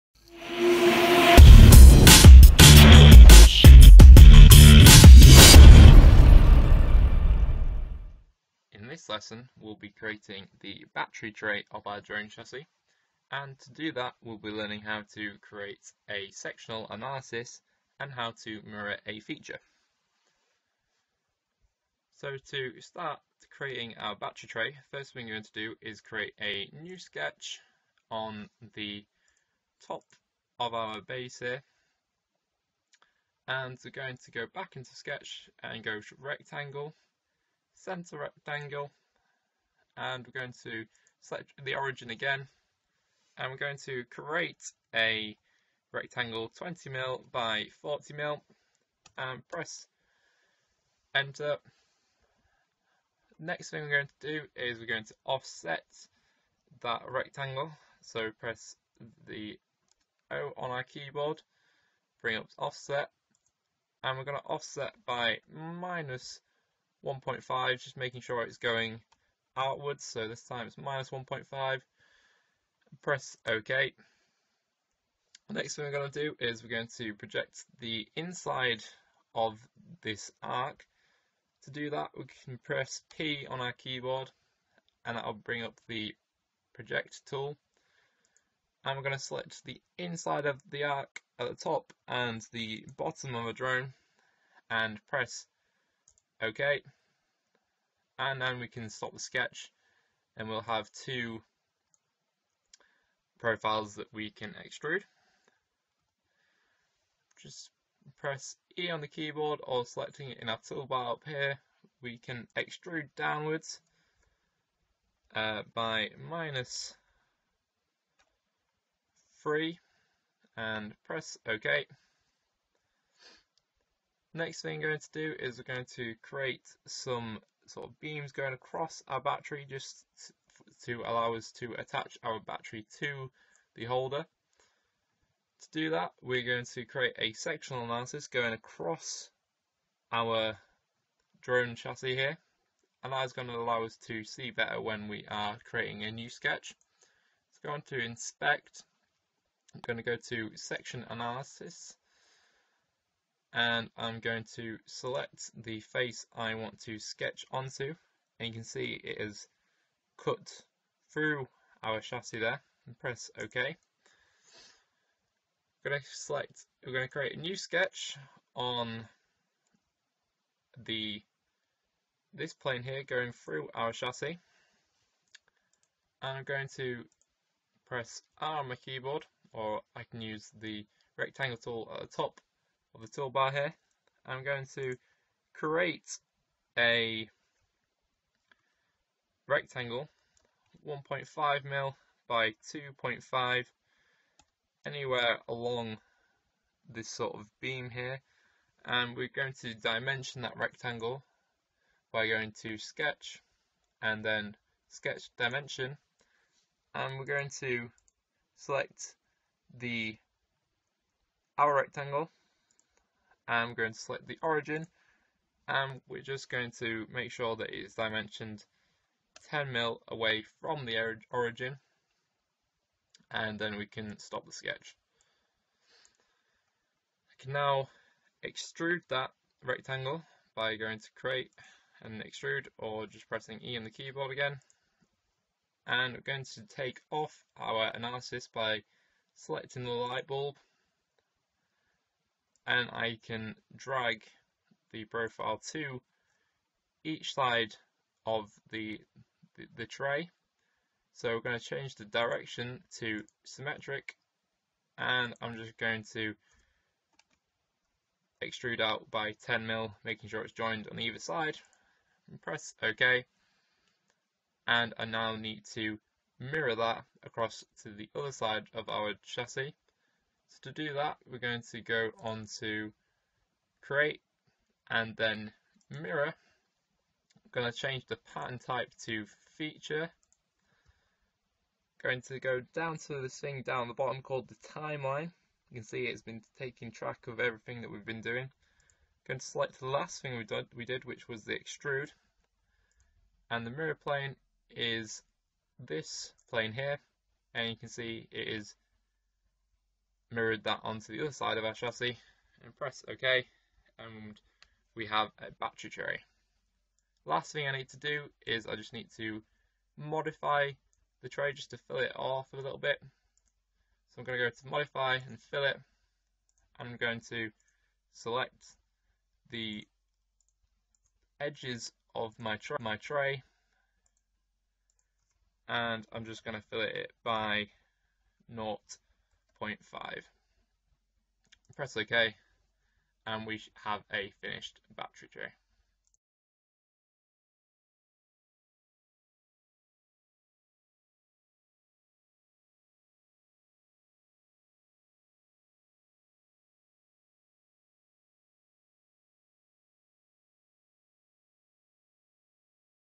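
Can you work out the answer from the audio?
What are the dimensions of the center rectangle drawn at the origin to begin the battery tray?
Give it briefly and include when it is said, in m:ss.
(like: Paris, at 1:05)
20mm by 40mm, at 0:46.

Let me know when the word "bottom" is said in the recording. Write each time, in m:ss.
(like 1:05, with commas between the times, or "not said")
1:32, 4:43.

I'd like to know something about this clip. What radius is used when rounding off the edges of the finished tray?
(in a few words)
0.5.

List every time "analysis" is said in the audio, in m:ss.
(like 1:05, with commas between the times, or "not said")
0:16, 2:17, 2:31, 3:57.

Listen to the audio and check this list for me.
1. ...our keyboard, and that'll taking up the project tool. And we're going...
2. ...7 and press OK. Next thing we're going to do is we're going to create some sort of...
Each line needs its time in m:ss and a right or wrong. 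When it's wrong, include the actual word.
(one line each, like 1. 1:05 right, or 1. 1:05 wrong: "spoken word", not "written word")
1. 1:23 wrong: "bring", not "taking"
2. 1:59 wrong: "3", not "7".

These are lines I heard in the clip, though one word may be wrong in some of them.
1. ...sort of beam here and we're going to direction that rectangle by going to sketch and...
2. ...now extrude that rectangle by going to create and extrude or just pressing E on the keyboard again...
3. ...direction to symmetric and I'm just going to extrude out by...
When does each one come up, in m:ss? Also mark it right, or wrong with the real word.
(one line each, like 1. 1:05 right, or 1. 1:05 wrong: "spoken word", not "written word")
1. 3:17 wrong: "dimension", not "direction"
2. 3:47 right
3. 4:12 right.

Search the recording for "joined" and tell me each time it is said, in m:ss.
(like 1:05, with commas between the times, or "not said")
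4:20.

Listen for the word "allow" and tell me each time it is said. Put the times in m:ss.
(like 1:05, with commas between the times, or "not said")
2:11, 2:23.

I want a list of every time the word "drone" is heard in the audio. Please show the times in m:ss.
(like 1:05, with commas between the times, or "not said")
0:12, 1:33, 2:21.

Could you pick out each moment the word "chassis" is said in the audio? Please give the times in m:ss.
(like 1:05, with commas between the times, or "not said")
0:12, 2:21, 2:41, 2:53, 4:29, 5:01.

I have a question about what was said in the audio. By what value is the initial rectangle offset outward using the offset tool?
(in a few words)
-1.5.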